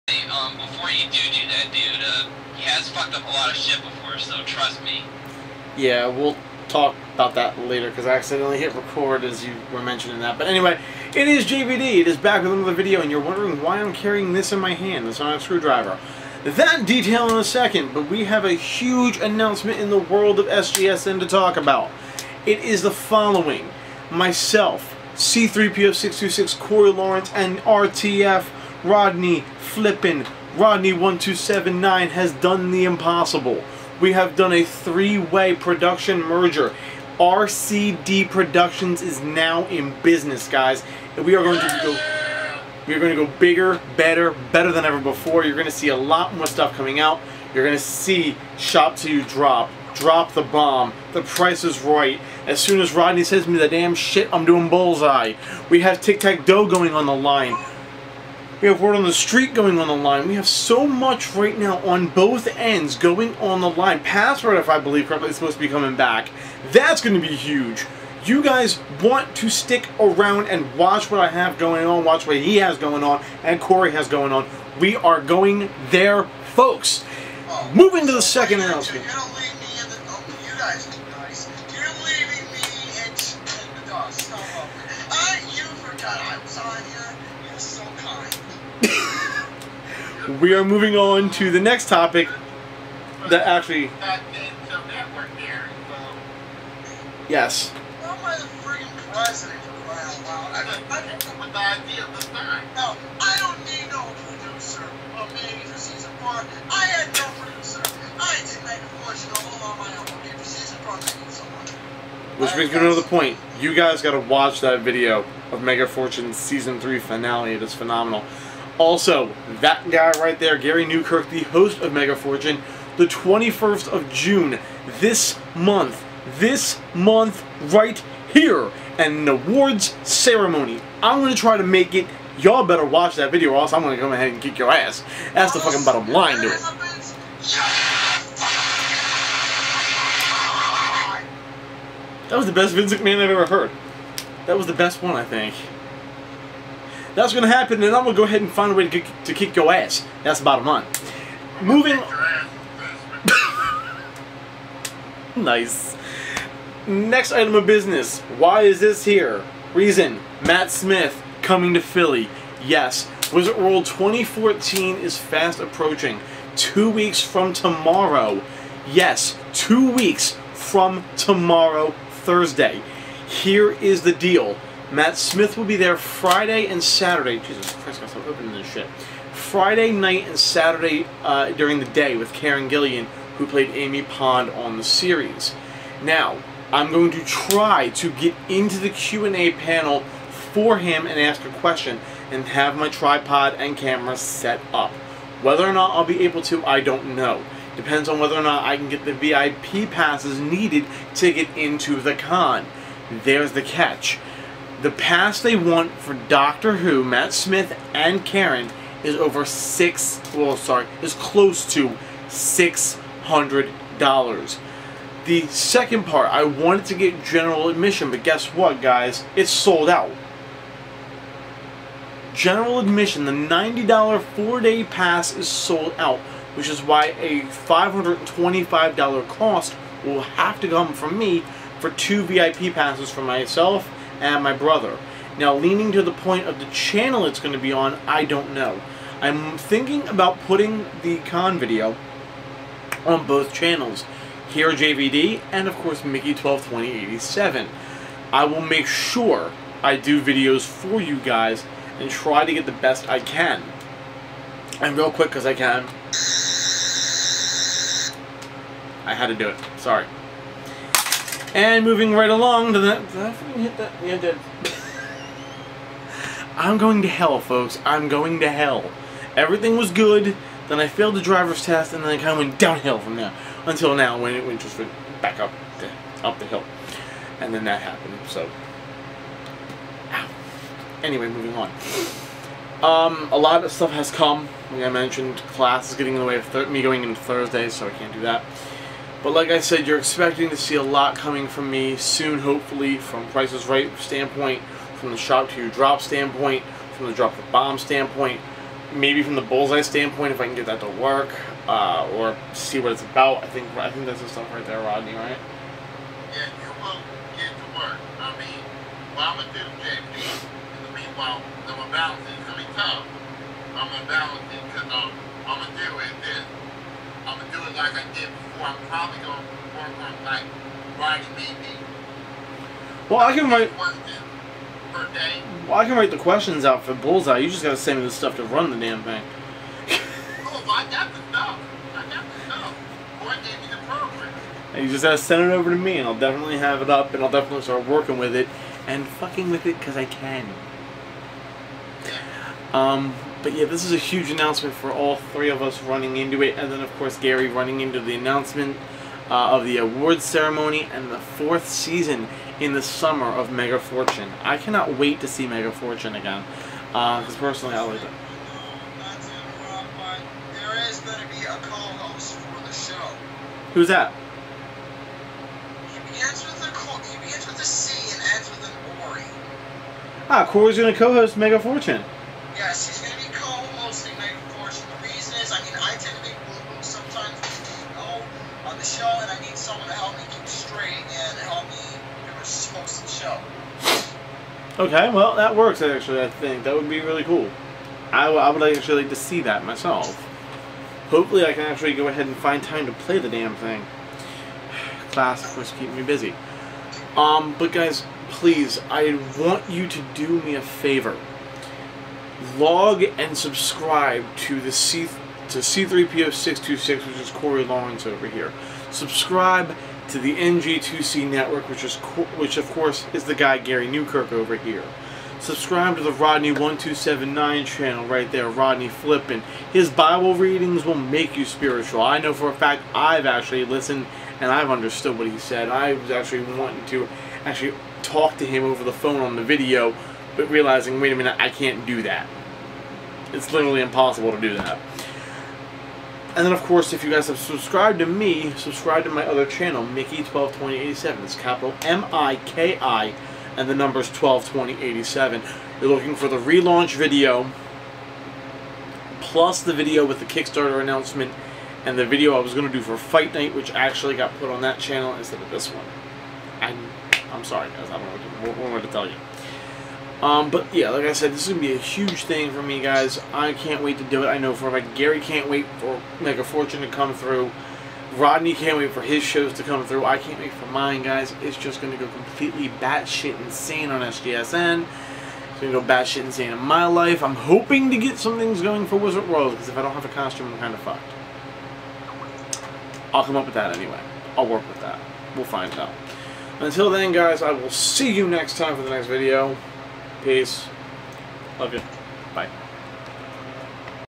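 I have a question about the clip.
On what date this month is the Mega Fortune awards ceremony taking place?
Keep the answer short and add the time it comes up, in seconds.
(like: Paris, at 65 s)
June 21, at 122 s.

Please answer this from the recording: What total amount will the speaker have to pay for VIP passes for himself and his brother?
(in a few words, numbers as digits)
$525.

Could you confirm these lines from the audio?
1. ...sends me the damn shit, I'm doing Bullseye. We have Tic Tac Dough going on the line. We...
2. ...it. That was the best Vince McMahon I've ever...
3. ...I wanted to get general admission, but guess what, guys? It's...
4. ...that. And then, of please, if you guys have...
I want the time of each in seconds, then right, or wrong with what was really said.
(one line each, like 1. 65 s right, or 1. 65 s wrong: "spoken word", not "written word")
1. 53 s right
2. 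136 s right
3. 216 s right
4. 434 s wrong: "course", not "please".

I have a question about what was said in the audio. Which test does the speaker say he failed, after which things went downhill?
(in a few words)
driver's test.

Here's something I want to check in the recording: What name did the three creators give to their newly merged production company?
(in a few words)
RCD Productions.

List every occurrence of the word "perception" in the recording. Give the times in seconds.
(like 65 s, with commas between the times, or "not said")
not said.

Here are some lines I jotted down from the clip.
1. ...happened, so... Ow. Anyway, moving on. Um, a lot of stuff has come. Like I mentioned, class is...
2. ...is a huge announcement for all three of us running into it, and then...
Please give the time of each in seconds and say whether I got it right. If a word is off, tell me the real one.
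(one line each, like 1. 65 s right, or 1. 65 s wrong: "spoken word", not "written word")
1. 277 s right
2. 343 s right.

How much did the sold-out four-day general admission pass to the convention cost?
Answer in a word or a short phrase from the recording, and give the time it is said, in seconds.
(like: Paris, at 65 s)
$90, at 223 s.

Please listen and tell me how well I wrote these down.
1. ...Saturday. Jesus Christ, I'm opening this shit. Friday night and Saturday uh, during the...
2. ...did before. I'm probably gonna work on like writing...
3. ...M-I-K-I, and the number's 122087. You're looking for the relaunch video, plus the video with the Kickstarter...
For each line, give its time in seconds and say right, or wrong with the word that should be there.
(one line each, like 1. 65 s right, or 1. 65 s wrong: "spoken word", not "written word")
1. 176 s right
2. 318 s right
3. 441 s right.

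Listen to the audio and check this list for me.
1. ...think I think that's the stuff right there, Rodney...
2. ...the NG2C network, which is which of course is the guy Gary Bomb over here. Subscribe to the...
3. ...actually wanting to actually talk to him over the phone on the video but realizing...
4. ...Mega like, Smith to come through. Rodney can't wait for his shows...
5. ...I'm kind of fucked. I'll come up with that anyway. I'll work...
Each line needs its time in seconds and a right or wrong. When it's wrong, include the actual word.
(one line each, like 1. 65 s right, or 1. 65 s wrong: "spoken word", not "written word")
1. 303 s right
2. 410 s wrong: "Newkirk", not "Bomb"
3. 426 s right
4. 466 s wrong: "Fortune", not "Smith"
5. 480 s right.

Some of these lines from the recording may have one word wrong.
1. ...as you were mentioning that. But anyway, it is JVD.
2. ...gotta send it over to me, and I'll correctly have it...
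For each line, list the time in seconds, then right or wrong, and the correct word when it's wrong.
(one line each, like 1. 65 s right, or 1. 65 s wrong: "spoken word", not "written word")
1. 9 s right
2. 335 s wrong: "definitely", not "correctly".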